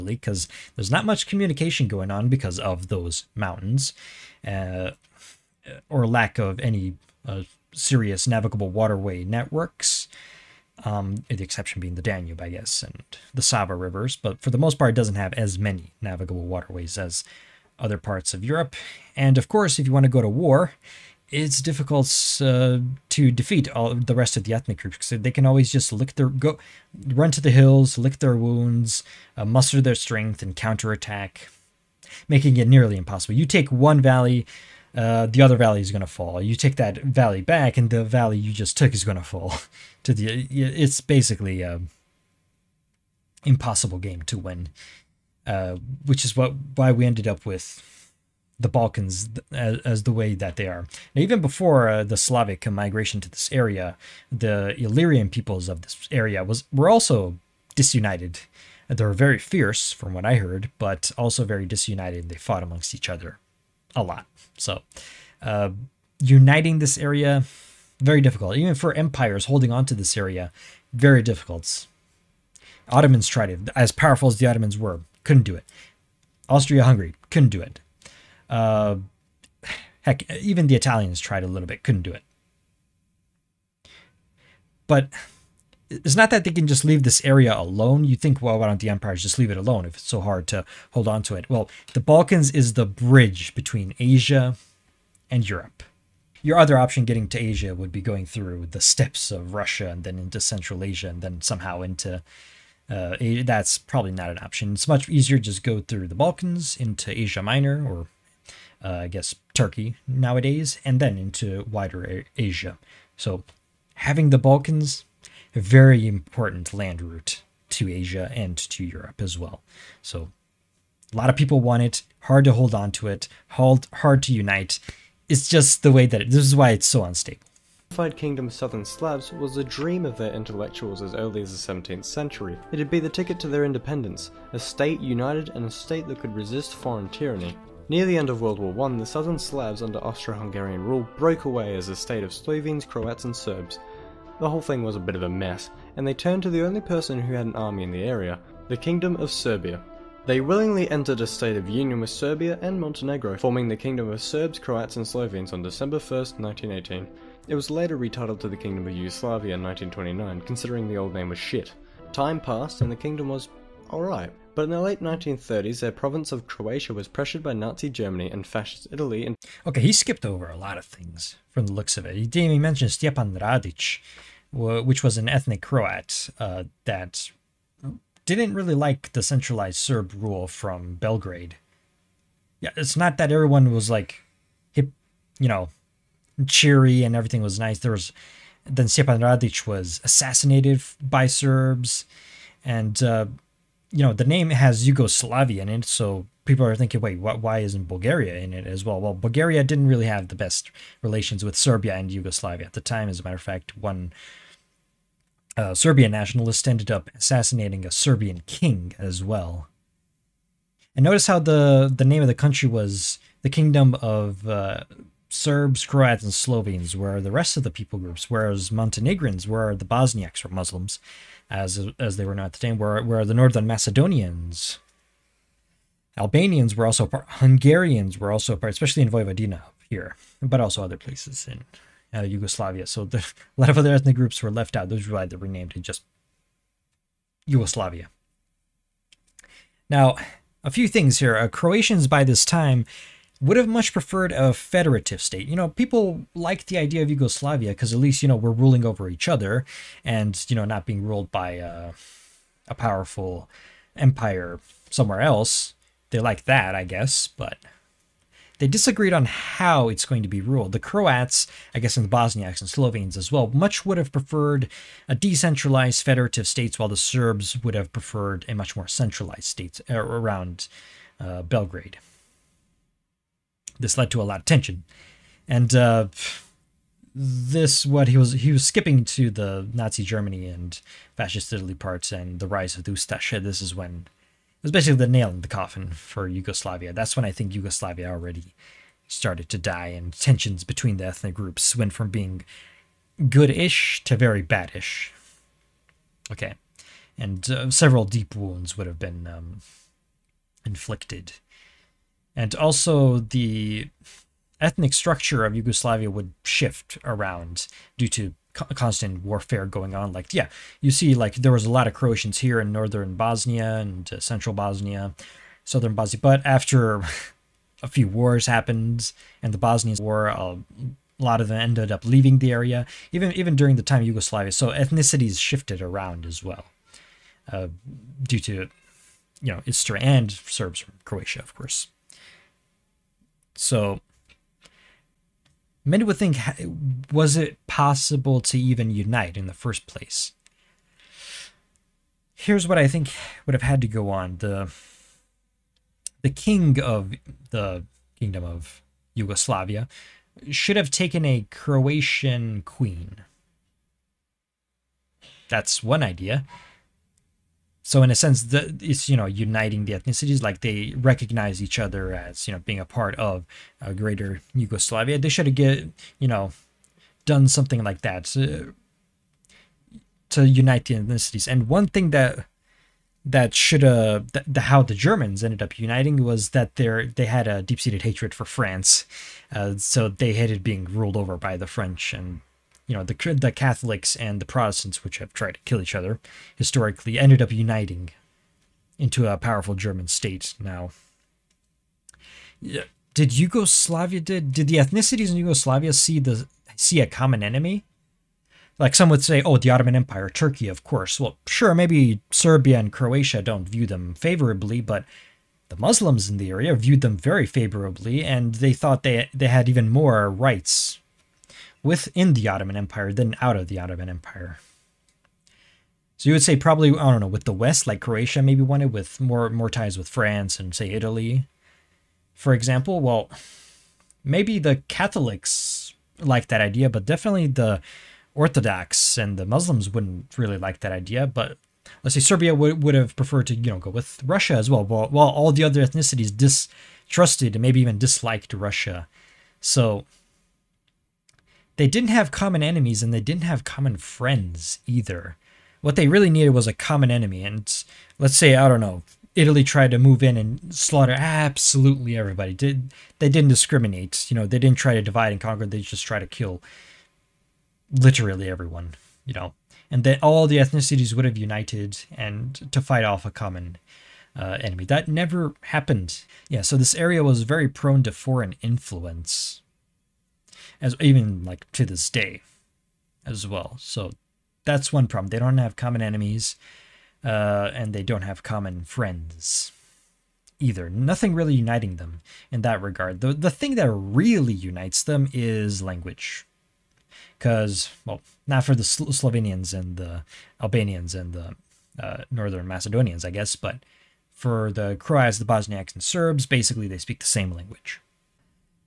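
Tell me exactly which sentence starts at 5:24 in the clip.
So ethnicities shifted around as well uh, due to, you know, Istria and Serbs from Croatia, of course.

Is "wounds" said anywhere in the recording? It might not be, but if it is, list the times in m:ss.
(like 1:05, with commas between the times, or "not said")
0:28, 4:58.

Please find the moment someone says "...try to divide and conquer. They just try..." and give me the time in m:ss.
7:34.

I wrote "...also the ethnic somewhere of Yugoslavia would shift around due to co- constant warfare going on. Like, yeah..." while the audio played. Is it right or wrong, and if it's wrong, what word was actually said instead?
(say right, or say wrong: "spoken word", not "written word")
wrong: "structure", not "somewhere".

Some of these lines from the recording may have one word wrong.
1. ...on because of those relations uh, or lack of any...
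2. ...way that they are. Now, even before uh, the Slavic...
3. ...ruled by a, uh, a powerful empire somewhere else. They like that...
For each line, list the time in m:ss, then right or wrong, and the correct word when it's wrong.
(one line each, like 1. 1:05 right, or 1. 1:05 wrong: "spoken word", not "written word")
1. 0:02 wrong: "mountains", not "relations"
2. 0:50 right
3. 4:11 right.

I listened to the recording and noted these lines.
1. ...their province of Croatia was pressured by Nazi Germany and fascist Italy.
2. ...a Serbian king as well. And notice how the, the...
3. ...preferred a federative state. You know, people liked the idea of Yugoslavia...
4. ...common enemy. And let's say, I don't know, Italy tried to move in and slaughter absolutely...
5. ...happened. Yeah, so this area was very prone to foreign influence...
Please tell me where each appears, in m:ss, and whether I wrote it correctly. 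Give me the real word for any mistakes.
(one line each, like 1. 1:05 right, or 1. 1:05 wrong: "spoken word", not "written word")
1. 2:45 right
2. 3:27 right
3. 4:03 right
4. 7:26 right
5. 7:45 right.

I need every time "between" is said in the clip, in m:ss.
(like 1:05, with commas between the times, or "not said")
1:33, 4:50.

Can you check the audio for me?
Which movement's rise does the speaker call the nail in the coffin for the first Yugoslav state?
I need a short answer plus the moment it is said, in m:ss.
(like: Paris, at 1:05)
Ustasha, at 4:42.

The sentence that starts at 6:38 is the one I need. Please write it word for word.
Like some would say, oh, the Ottoman Empire, Turkey, of course.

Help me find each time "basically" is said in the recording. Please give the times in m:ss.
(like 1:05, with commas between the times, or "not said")
0:41, 4:44, 8:16.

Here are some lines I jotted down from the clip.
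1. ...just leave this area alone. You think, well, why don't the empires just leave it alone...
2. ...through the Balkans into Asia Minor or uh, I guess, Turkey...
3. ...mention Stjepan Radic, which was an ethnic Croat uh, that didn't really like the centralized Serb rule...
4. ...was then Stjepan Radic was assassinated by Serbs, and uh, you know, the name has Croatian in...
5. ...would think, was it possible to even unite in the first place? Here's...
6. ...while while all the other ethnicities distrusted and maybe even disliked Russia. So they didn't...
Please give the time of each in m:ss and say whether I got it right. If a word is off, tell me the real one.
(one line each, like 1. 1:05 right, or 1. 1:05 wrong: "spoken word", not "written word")
1. 1:26 right
2. 1:45 right
3. 2:52 right
4. 3:07 wrong: "Yugoslavia", not "Croatian"
5. 5:36 right
6. 7:14 right.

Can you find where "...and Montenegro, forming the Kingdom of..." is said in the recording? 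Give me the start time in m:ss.
2:32.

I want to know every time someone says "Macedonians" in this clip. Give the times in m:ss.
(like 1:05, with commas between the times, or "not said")
3:43, 8:12.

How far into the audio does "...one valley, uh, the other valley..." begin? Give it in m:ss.
0:33.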